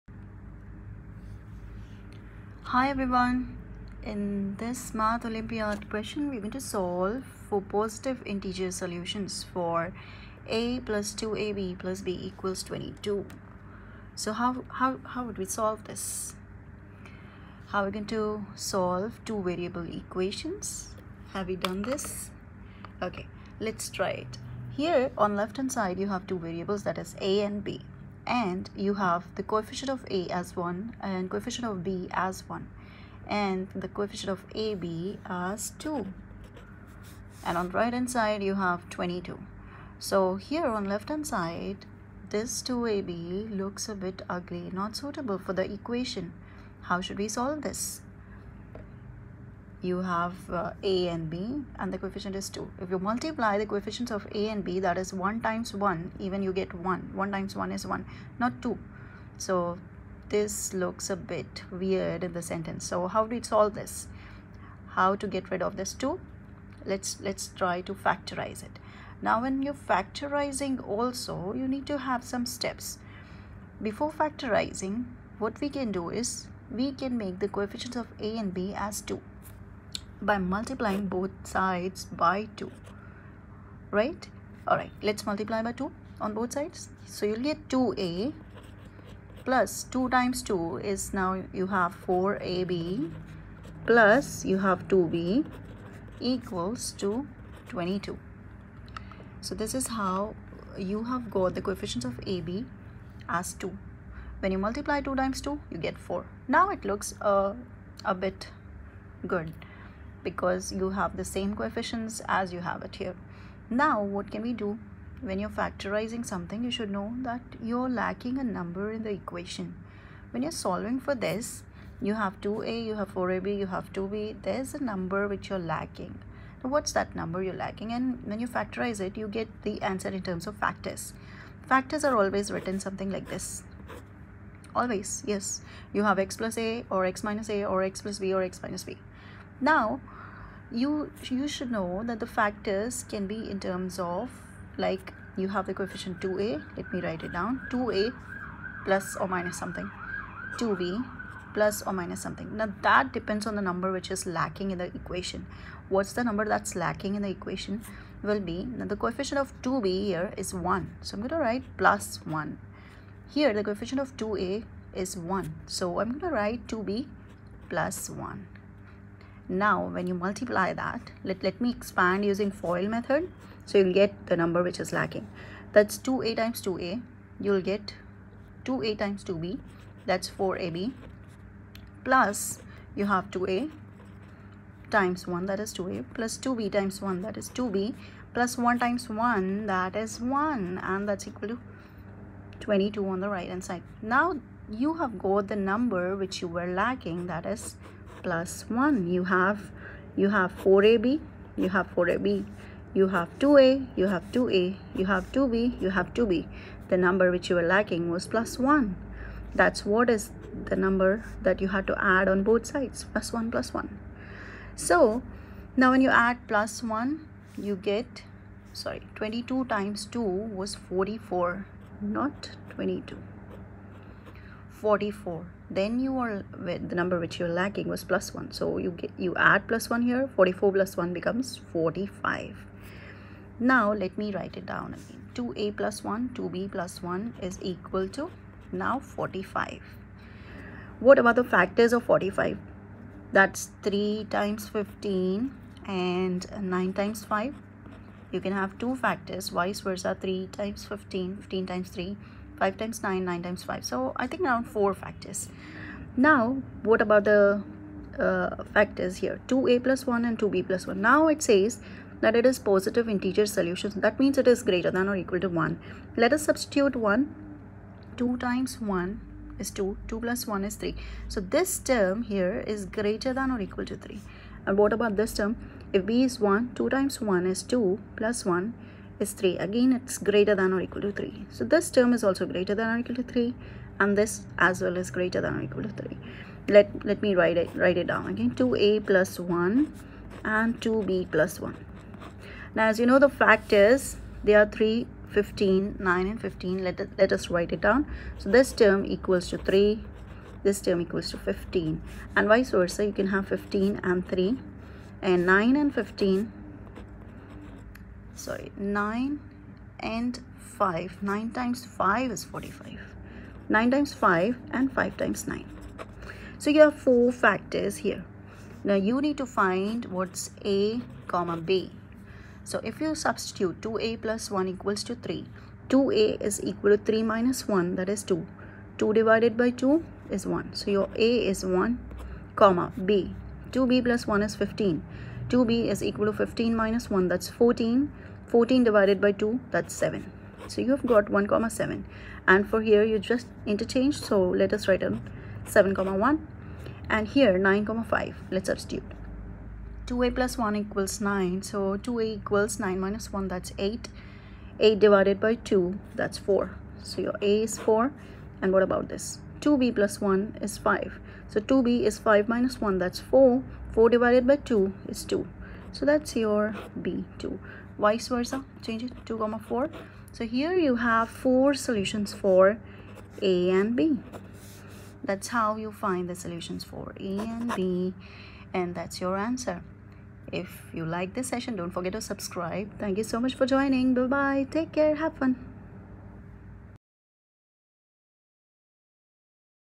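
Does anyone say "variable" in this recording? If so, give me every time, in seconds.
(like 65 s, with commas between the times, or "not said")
19 s, 26 s.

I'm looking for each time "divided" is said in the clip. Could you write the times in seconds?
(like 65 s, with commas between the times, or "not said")
329 s, 338 s, 355 s, 364 s.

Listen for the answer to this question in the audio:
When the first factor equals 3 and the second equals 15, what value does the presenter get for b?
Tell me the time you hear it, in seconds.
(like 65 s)
339 s.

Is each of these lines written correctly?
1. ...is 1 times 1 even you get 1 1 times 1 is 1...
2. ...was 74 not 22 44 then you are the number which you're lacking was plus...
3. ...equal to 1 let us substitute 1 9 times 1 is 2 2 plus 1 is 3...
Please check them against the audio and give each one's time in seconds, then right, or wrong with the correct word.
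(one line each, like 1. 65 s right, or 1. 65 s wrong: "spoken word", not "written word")
1. 55 s right
2. 220 s wrong: "44", not "74"
3. 265 s wrong: "2", not "9".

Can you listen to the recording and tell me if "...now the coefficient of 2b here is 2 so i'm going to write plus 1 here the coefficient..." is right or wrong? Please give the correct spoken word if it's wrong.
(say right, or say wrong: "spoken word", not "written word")
wrong: "1", not "2".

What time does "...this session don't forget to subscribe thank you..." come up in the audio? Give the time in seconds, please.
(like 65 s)
381 s.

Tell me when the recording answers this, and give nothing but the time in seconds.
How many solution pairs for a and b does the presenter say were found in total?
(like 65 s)
371 s.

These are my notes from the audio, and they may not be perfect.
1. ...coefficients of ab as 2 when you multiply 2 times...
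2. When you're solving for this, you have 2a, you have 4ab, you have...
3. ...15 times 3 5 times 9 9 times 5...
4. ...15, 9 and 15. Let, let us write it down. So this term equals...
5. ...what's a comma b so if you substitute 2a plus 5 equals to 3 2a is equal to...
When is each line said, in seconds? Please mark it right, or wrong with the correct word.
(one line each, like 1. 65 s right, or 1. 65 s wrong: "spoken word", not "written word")
1. 101 s right
2. 120 s right
3. 251 s right
4. 295 s right
5. 320 s wrong: "1", not "5".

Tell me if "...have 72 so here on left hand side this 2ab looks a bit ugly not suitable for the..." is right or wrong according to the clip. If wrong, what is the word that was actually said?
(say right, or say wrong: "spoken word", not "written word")
wrong: "22", not "72".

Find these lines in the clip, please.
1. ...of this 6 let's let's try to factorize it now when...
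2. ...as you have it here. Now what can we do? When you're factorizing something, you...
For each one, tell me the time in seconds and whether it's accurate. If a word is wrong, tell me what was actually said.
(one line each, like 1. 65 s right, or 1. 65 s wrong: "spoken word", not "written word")
1. 65 s wrong: "2", not "6"
2. 112 s right.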